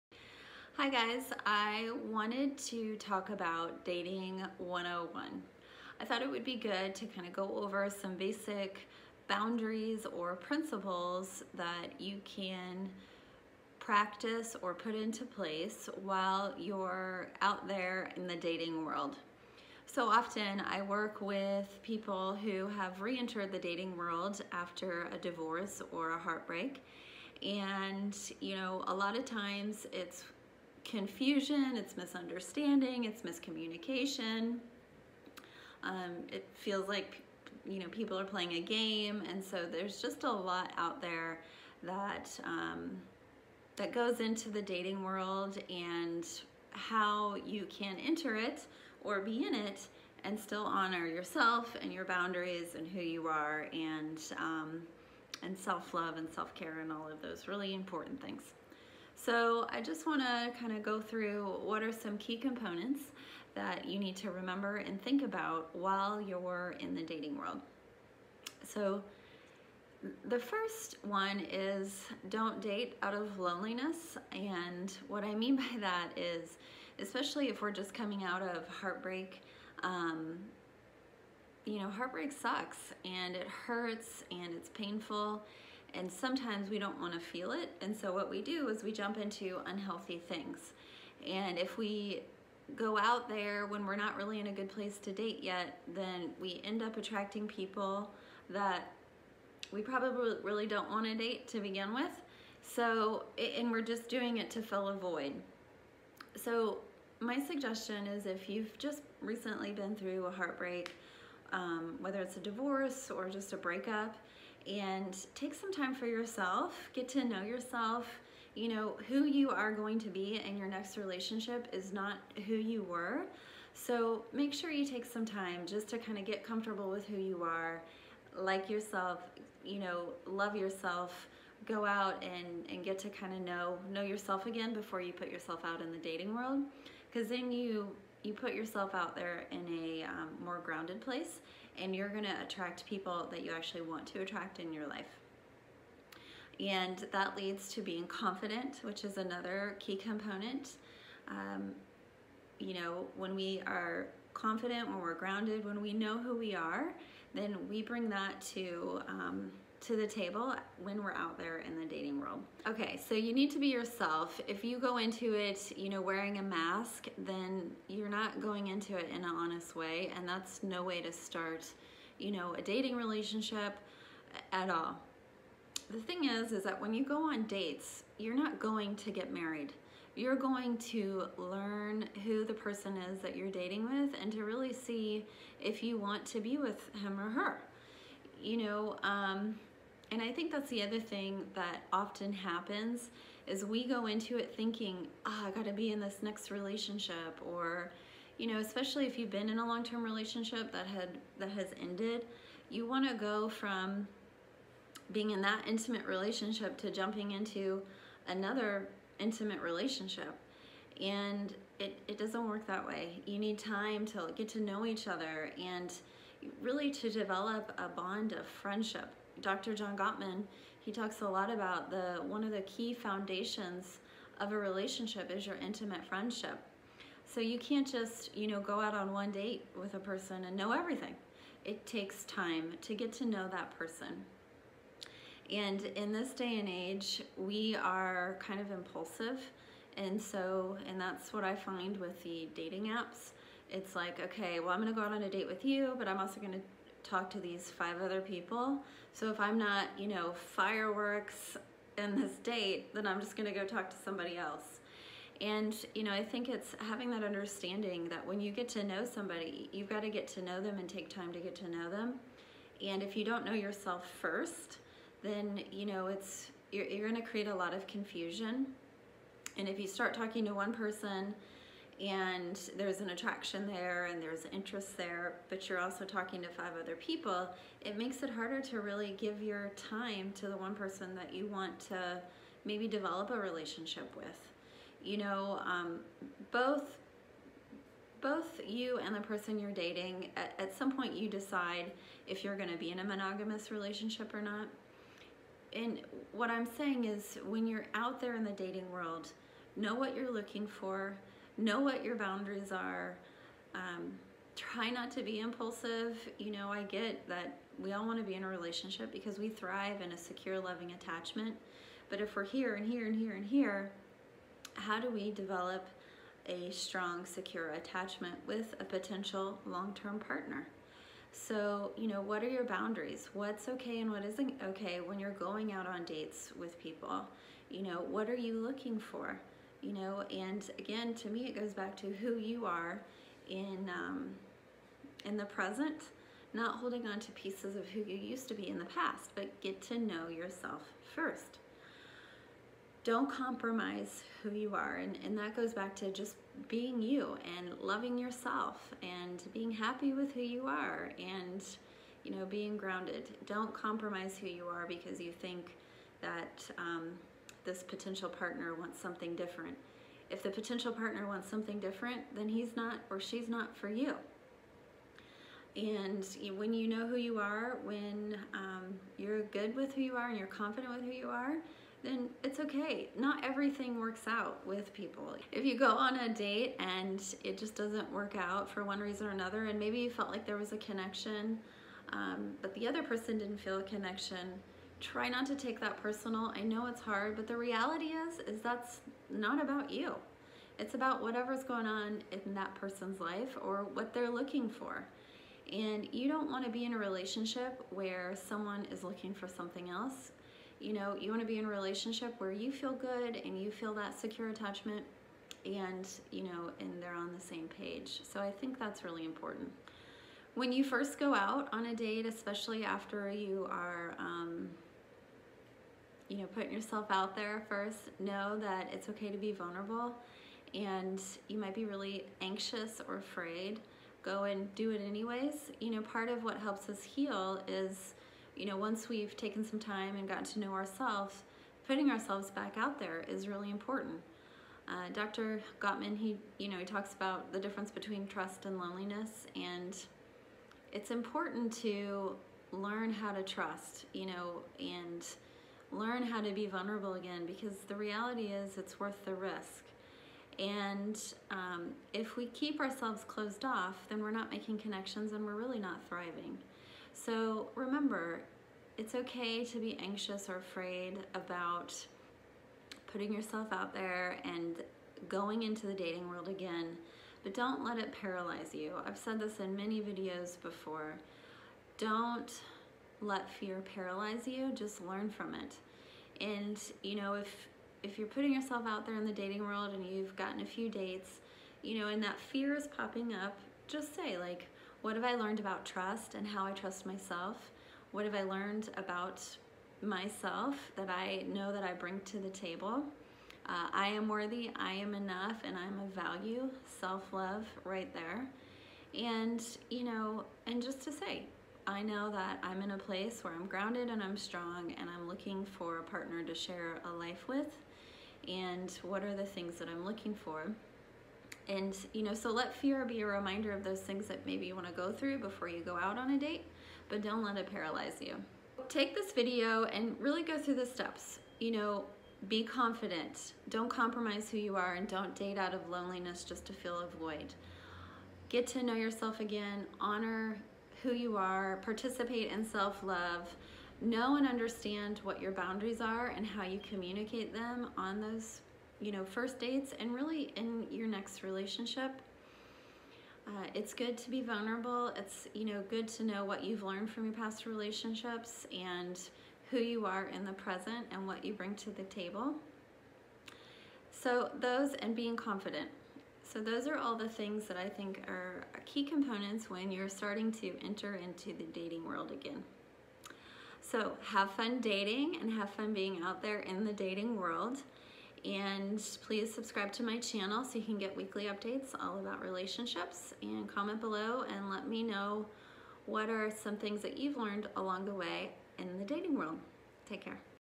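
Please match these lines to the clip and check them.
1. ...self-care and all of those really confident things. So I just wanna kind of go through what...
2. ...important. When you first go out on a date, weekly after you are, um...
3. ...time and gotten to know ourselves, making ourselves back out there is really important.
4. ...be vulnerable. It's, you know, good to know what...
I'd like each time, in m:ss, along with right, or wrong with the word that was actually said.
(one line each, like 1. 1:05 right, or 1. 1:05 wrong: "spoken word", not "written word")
1. 0:56 wrong: "important", not "confident"
2. 6:49 wrong: "especially", not "weekly"
3. 7:09 wrong: "putting", not "making"
4. 9:04 right.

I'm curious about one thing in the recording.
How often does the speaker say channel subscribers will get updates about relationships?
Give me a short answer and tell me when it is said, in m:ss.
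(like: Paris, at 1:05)
Weekly, at 9:31.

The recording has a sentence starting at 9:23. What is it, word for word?
So have fun dating and have fun being out there in the dating world.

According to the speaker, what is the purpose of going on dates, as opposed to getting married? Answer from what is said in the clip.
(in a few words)
To learn who the person is.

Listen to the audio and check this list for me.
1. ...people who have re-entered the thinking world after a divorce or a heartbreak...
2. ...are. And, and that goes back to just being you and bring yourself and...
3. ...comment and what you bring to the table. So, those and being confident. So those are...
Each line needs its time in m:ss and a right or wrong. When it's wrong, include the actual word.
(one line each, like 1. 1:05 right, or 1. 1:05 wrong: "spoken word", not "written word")
1. 0:21 wrong: "dating", not "thinking"
2. 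5:44 wrong: "loving", not "bring"
3. 9:10 wrong: "present", not "comment".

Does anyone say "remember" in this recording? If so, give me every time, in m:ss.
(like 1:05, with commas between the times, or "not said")
1:04, 7:37.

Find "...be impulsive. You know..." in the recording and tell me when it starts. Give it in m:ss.
5:05.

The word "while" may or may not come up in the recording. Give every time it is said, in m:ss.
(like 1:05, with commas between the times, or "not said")
0:16, 1:05.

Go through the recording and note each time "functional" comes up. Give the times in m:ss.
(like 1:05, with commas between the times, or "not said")
not said.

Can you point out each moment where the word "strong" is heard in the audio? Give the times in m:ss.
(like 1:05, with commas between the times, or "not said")
5:16, 8:24.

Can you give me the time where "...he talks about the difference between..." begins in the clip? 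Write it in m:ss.
7:16.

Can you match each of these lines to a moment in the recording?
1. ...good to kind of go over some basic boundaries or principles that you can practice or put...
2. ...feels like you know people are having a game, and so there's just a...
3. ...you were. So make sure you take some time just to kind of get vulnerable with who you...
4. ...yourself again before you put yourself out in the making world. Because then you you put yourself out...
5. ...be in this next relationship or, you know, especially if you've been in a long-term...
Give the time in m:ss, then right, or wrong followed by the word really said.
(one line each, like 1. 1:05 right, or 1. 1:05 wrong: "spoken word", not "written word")
1. 0:06 right
2. 0:36 wrong: "playing", not "having"
3. 2:02 wrong: "comfortable", not "vulnerable"
4. 2:14 wrong: "dating", not "making"
5. 3:15 right.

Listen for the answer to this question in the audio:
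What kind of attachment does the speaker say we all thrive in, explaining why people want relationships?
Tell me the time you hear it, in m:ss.
5:10.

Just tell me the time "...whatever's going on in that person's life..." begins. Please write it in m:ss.
6:31.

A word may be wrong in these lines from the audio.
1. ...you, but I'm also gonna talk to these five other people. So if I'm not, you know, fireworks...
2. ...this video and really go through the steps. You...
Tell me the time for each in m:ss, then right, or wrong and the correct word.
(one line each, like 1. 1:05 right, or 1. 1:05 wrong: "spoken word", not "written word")
1. 4:05 right
2. 8:39 right.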